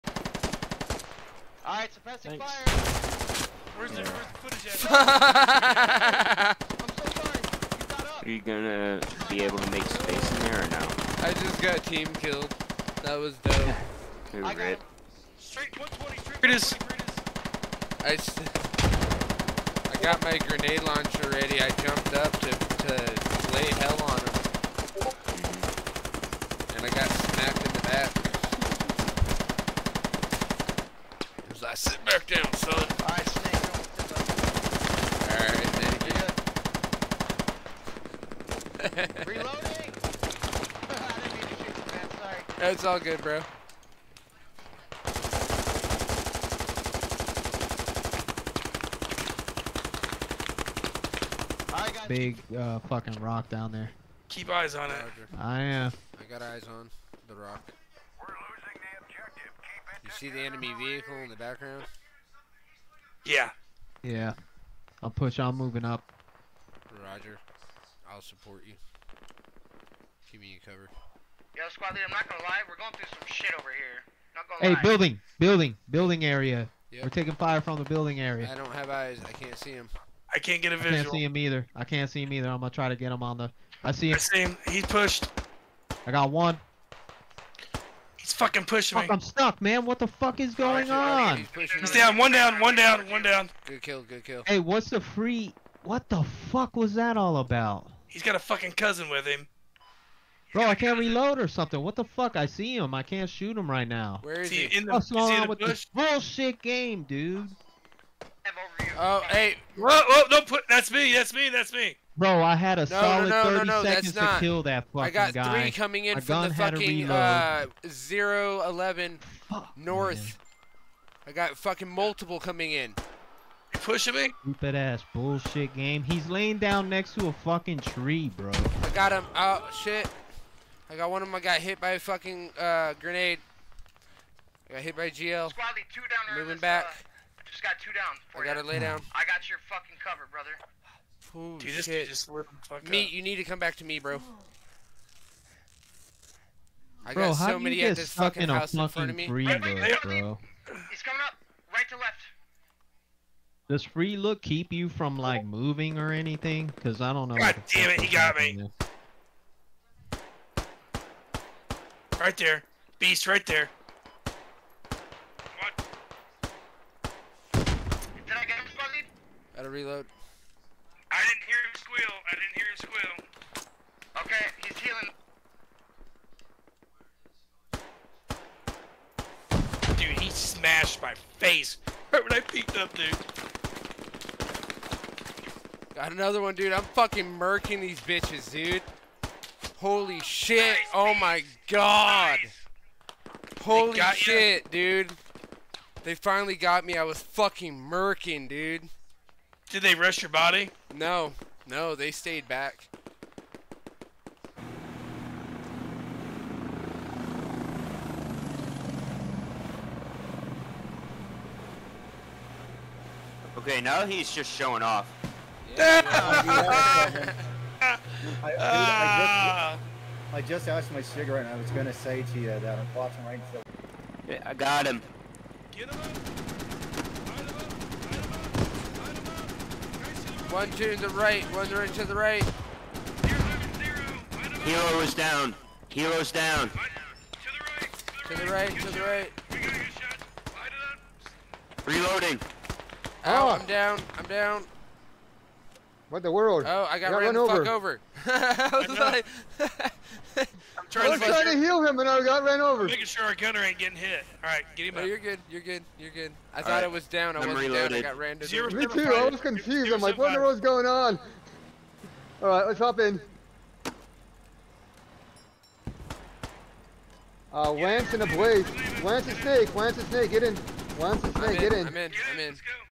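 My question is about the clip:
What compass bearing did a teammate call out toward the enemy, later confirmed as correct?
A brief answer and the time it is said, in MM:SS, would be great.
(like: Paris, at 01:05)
120, at 00:15.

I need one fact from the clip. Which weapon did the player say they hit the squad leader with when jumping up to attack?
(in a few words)
grenade launcher.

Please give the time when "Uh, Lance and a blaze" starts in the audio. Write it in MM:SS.
04:27.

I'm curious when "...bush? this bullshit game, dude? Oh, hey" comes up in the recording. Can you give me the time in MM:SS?
01:45.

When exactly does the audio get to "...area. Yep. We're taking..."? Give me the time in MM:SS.
01:16.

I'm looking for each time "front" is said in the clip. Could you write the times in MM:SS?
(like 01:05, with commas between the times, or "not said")
02:28.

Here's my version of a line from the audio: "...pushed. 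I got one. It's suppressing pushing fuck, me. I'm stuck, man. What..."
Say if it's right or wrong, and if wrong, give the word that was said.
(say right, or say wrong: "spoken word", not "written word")
wrong: "fucking", not "suppressing".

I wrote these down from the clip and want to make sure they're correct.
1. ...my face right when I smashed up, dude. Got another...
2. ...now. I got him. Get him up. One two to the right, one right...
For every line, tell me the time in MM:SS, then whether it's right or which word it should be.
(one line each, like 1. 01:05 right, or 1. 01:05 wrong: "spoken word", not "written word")
1. 03:01 wrong: "peeked", not "smashed"
2. 03:44 right.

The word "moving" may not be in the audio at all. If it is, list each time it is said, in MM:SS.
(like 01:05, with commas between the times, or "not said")
01:05, 02:16, 02:35.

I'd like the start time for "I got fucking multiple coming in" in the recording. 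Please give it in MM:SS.
02:01.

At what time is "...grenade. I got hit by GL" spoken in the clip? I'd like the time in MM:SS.
02:12.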